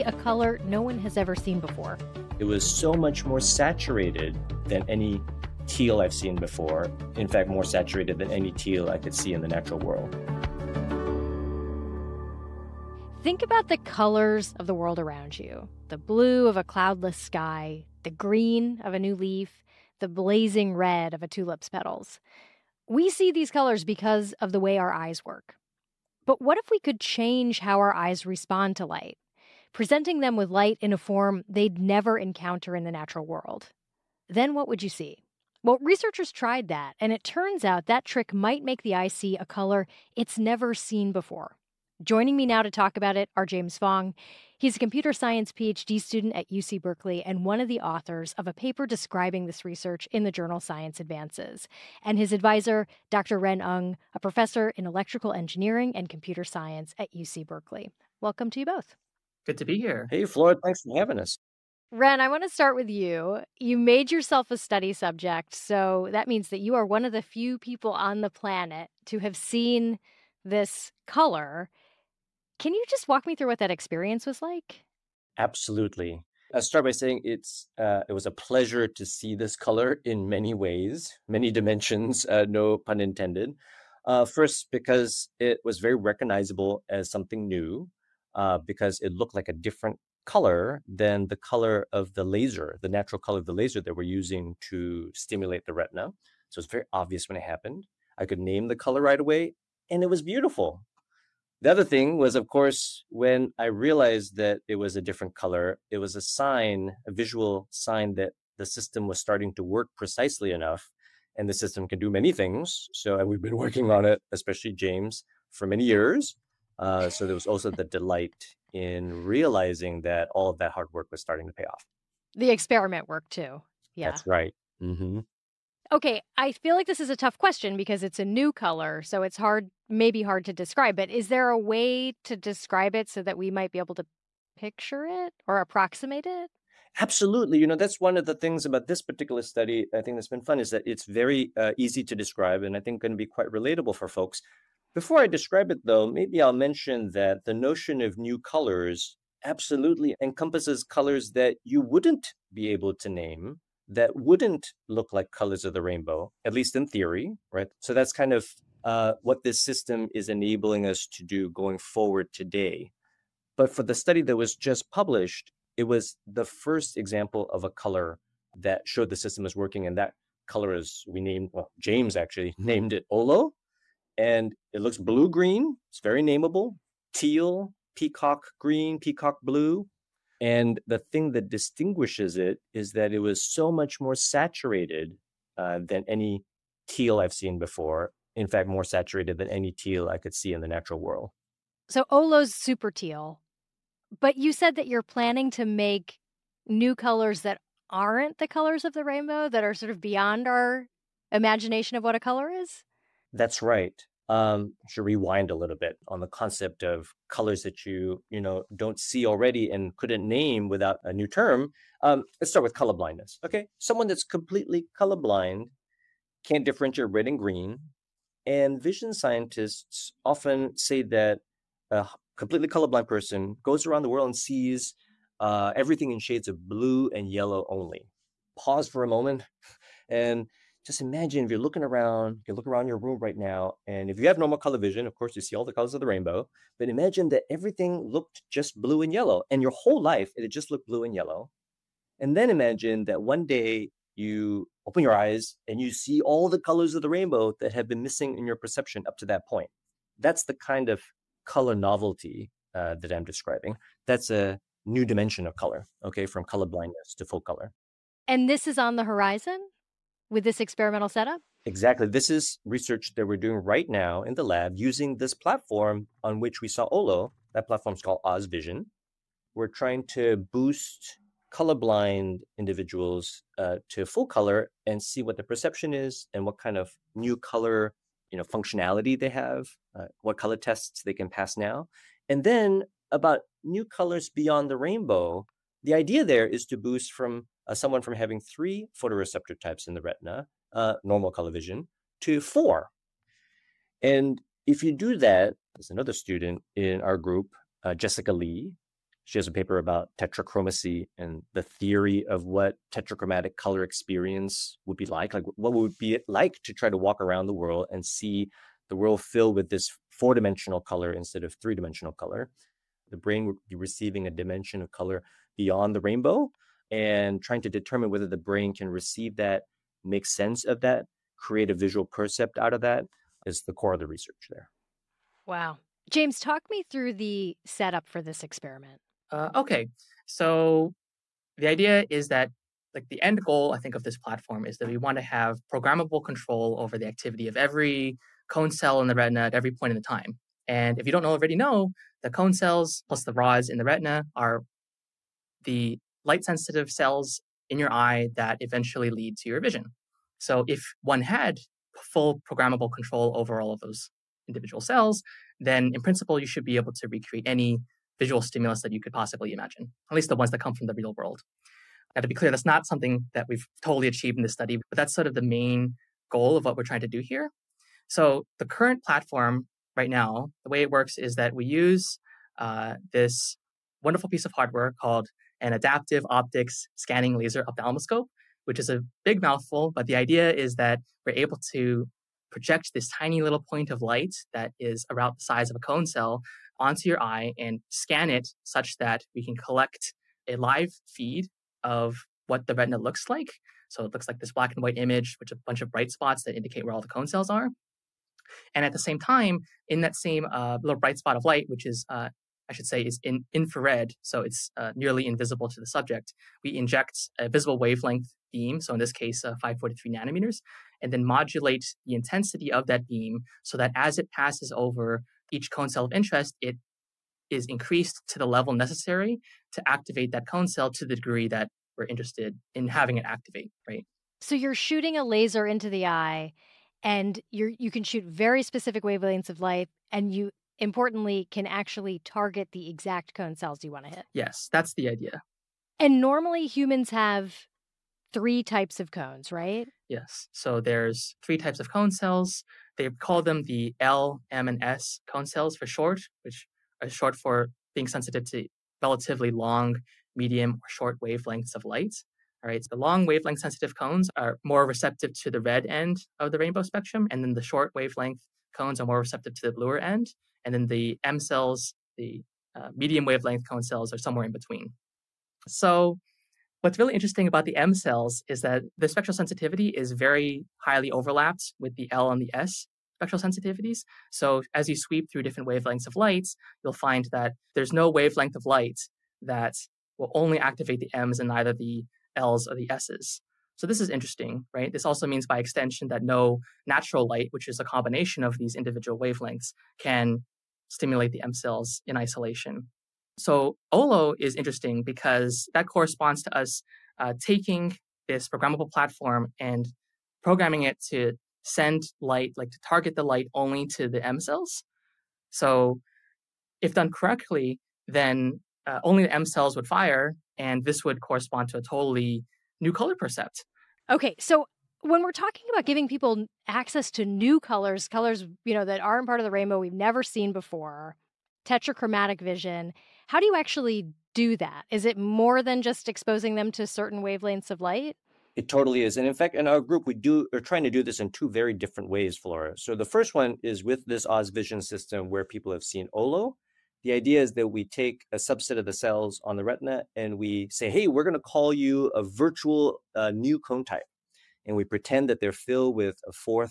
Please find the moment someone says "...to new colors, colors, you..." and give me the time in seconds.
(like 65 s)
517 s.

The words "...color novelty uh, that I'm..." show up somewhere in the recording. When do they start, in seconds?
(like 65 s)
251 s.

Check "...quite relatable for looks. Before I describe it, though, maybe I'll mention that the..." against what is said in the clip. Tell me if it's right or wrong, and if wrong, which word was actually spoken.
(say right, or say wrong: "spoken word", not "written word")
wrong: "folks", not "looks".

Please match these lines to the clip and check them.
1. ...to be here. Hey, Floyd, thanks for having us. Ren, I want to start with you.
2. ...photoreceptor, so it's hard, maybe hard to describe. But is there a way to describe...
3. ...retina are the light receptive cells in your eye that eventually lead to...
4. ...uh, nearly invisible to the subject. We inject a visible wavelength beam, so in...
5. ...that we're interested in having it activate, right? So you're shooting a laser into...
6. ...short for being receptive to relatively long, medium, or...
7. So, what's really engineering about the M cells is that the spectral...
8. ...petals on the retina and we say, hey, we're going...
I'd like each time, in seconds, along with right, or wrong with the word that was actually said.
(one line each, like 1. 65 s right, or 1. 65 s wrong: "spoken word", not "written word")
1. 59 s right
2. 128 s wrong: "color", not "photoreceptor"
3. 343 s wrong: "sensitive", not "receptive"
4. 404 s right
5. 421 s right
6. 447 s wrong: "sensitive", not "receptive"
7. 465 s wrong: "interesting", not "engineering"
8. 538 s wrong: "cells", not "petals".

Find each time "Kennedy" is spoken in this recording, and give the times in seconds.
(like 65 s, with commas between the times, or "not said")
not said.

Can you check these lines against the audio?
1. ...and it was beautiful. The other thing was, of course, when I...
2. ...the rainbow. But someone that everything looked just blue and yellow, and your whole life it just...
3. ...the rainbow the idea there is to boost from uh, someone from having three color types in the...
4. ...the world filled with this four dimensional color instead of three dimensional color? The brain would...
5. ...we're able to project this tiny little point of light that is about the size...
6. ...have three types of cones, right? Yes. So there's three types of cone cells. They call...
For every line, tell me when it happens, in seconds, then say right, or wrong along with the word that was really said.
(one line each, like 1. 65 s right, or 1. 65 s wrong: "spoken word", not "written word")
1. 99 s right
2. 236 s wrong: "imagine", not "someone"
3. 284 s wrong: "photoreceptor", not "color"
4. 308 s right
5. 381 s right
6. 437 s right.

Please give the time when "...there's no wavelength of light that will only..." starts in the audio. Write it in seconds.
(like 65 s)
477 s.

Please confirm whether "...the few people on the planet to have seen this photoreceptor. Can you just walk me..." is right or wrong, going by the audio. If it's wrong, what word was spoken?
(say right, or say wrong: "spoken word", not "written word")
wrong: "color", not "photoreceptor".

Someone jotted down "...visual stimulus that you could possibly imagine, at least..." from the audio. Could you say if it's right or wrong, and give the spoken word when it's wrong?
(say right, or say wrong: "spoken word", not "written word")
right.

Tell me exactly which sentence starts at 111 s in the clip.
And the system can do many things.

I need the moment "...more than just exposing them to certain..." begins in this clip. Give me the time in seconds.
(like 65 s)
525 s.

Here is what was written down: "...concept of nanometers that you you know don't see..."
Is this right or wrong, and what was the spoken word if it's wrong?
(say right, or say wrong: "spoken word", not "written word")
wrong: "colors", not "nanometers".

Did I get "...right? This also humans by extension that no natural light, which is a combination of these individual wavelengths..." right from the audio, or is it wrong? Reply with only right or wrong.
wrong.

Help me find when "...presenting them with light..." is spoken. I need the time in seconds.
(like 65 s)
29 s.